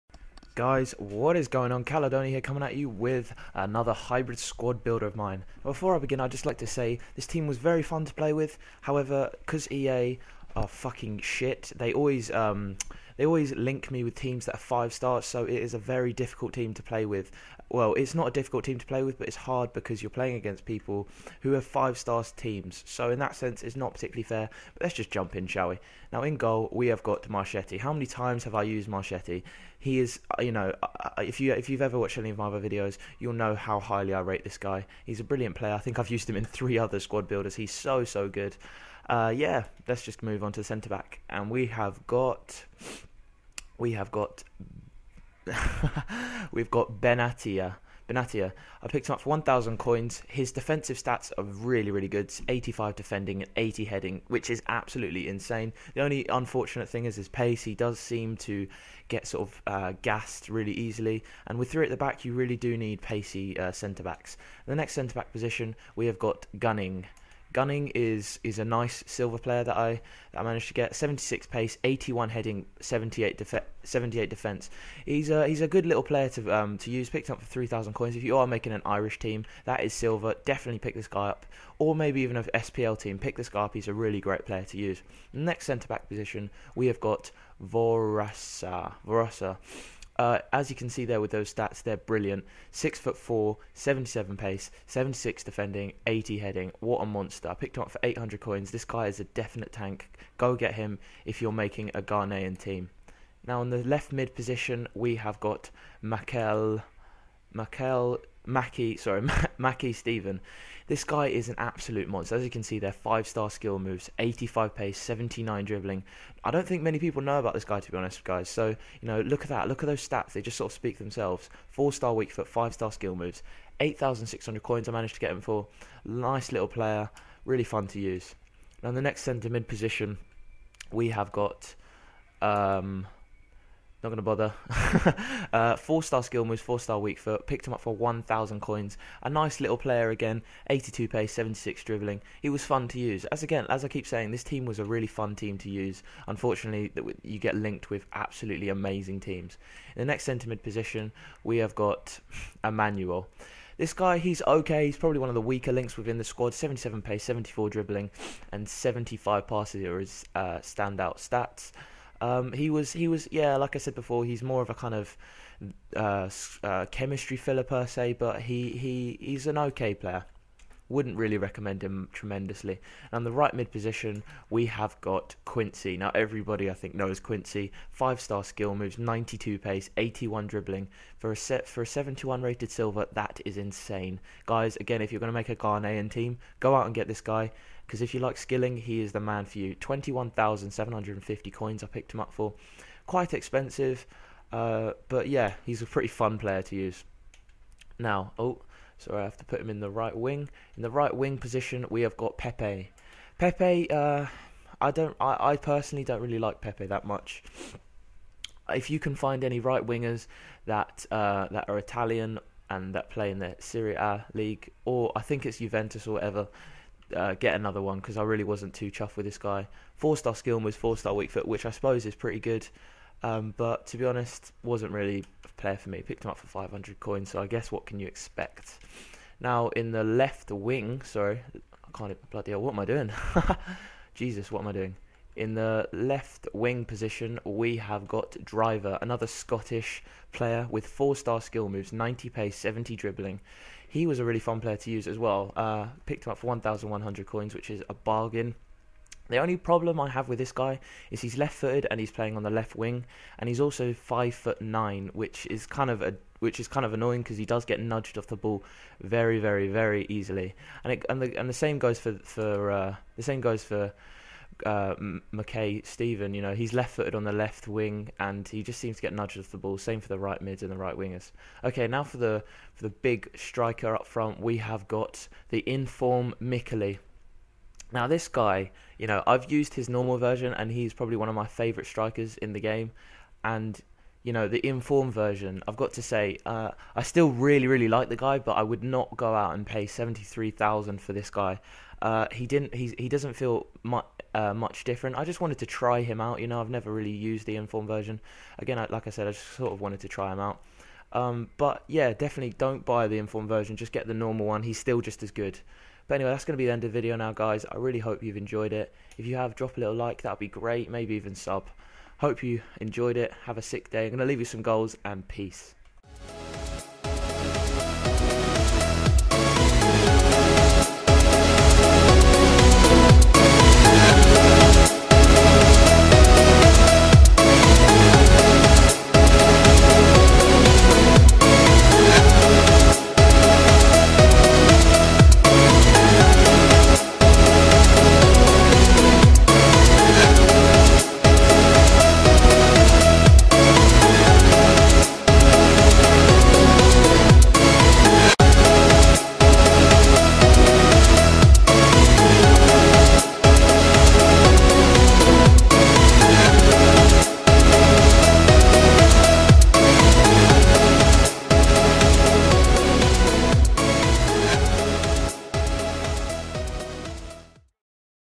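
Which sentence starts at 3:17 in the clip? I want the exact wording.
Now, oh, so I have to put him in the right wing.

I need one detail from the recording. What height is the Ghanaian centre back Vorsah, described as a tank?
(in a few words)
6 foot 4.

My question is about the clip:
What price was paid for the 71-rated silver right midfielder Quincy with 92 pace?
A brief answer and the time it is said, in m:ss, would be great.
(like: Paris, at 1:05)
21,750 coins, at 3:09.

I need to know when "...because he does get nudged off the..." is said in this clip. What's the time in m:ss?
4:17.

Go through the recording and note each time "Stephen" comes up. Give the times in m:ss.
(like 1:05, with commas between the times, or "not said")
1:49, 4:25.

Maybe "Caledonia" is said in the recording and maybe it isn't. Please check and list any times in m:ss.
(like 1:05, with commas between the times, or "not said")
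0:01.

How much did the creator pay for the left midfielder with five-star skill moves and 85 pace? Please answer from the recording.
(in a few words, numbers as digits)
8,600 coins.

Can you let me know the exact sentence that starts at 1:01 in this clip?
And with three at the back, you really do need pacey uh, centre backs.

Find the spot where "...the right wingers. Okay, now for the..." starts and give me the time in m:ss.
4:30.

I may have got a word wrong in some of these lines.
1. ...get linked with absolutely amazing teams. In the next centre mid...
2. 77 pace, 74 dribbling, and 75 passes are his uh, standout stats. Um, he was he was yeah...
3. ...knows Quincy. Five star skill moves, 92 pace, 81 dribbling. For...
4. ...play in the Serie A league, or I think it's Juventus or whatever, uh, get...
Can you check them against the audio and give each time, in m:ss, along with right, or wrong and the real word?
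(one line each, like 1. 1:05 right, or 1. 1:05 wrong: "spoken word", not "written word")
1. 2:27 right
2. 2:36 right
3. 2:56 right
4. 3:33 right.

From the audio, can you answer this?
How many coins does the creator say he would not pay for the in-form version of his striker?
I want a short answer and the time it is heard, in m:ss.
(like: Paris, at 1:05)
73,000, at 4:49.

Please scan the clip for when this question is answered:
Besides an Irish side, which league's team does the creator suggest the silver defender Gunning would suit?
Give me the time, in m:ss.
1:22.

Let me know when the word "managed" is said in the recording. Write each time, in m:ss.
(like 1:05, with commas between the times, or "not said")
1:10, 2:04.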